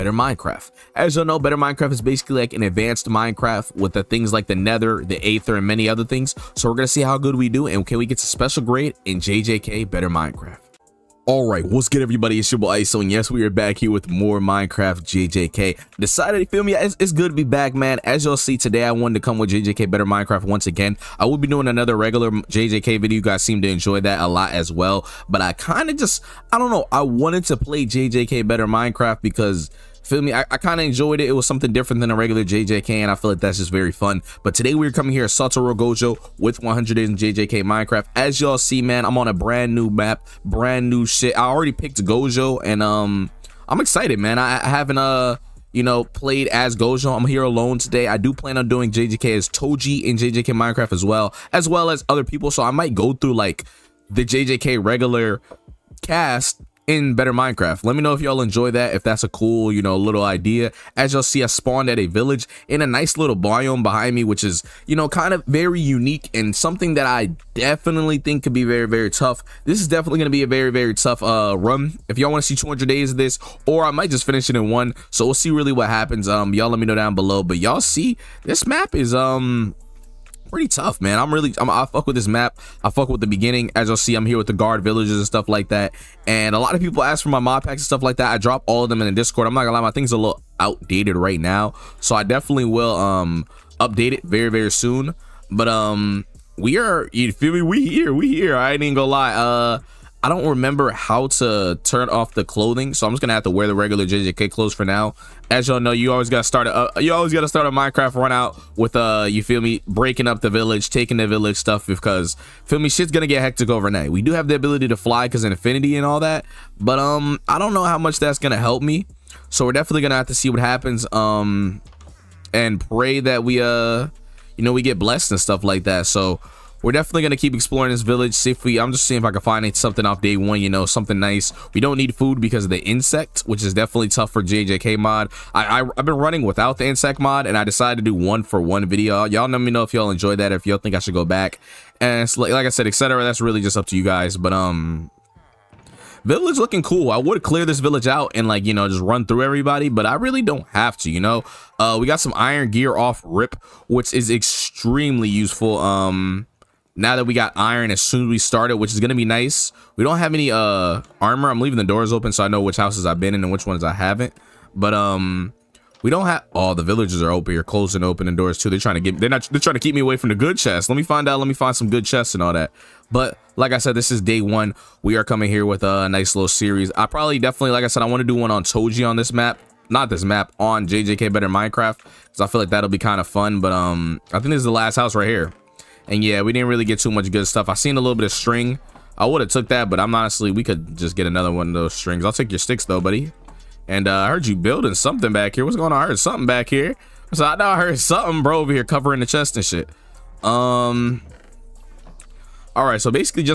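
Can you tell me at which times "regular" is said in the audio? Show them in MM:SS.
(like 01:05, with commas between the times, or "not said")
00:21, 00:32, 00:54, 01:43.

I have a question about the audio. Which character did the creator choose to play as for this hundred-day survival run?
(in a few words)
Satoru Gojo.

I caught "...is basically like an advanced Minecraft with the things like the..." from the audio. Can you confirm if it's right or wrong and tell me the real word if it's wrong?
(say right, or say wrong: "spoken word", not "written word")
right.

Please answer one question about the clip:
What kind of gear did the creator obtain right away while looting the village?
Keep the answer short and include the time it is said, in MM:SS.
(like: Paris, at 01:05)
Iron gear, at 02:32.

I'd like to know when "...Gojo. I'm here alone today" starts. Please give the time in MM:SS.
00:46.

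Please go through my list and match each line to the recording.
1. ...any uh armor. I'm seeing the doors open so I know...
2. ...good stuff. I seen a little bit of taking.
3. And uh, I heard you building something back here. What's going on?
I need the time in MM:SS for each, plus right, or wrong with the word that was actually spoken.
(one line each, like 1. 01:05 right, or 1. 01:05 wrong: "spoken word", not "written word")
1. 02:40 wrong: "leaving", not "seeing"
2. 03:07 wrong: "string", not "taking"
3. 03:13 right.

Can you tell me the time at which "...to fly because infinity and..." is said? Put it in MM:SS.
01:54.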